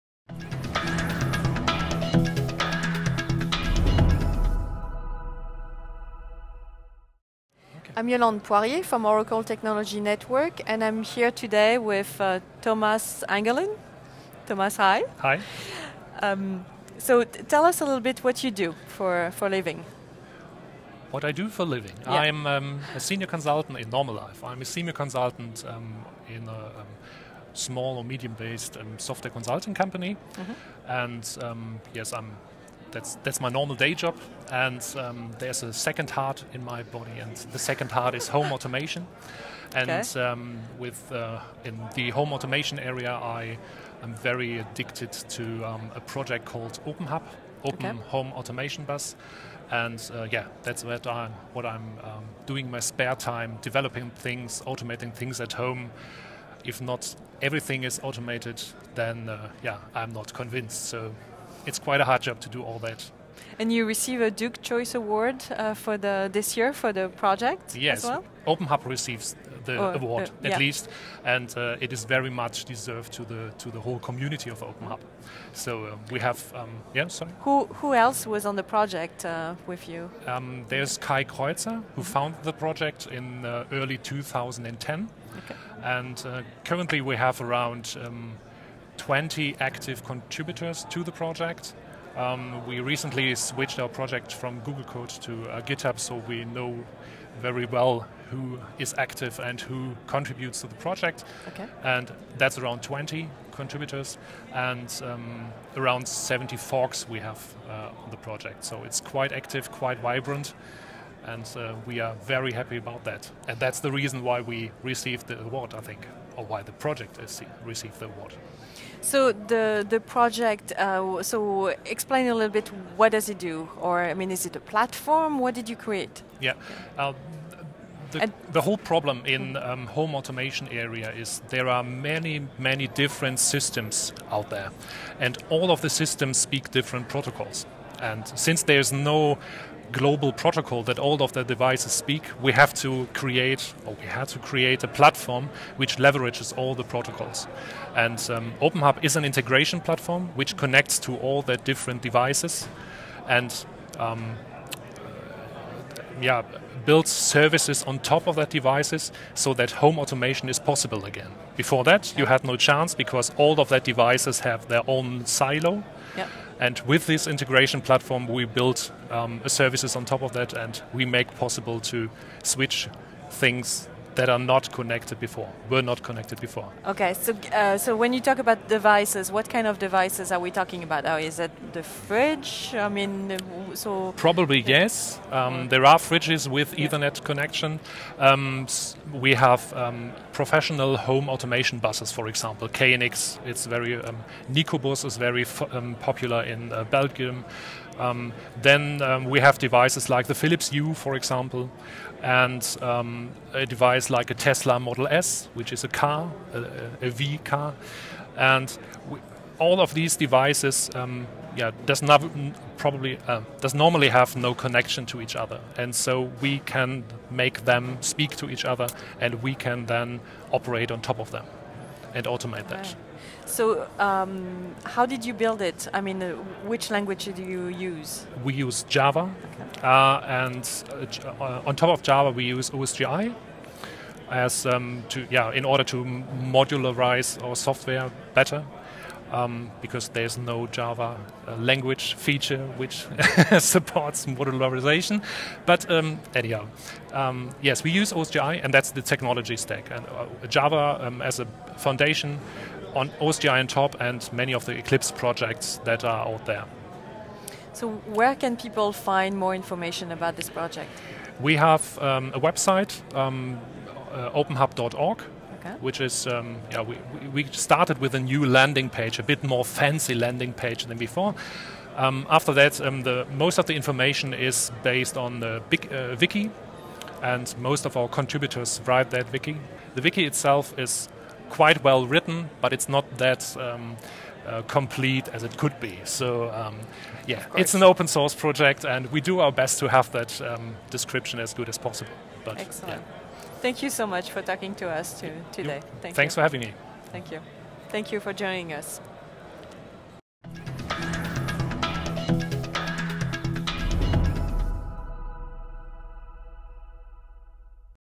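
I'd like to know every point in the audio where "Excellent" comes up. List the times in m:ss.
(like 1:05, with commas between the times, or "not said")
4:52.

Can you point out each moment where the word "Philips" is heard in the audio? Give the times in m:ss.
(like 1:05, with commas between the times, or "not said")
3:20.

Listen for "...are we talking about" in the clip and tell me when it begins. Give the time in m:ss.
3:00.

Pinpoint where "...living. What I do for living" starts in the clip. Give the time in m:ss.
0:19.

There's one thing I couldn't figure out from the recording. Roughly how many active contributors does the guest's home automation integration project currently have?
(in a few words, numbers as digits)
20.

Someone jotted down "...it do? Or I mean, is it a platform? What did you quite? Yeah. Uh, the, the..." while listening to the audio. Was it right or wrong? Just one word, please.
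wrong.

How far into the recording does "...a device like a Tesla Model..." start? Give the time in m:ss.
3:23.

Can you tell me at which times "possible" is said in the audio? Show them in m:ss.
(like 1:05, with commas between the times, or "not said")
2:40, 2:51, 4:51.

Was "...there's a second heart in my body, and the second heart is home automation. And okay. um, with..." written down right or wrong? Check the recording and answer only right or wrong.
right.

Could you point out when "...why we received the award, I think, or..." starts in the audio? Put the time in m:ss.
1:54.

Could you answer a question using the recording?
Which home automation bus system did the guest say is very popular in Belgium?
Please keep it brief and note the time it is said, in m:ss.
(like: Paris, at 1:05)
Nikobus, at 3:14.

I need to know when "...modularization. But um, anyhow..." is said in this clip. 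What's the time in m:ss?
4:04.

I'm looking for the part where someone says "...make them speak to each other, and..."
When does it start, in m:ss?
3:37.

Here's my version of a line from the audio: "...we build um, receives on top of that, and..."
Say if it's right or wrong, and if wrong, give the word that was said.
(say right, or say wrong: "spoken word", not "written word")
wrong: "services", not "receives".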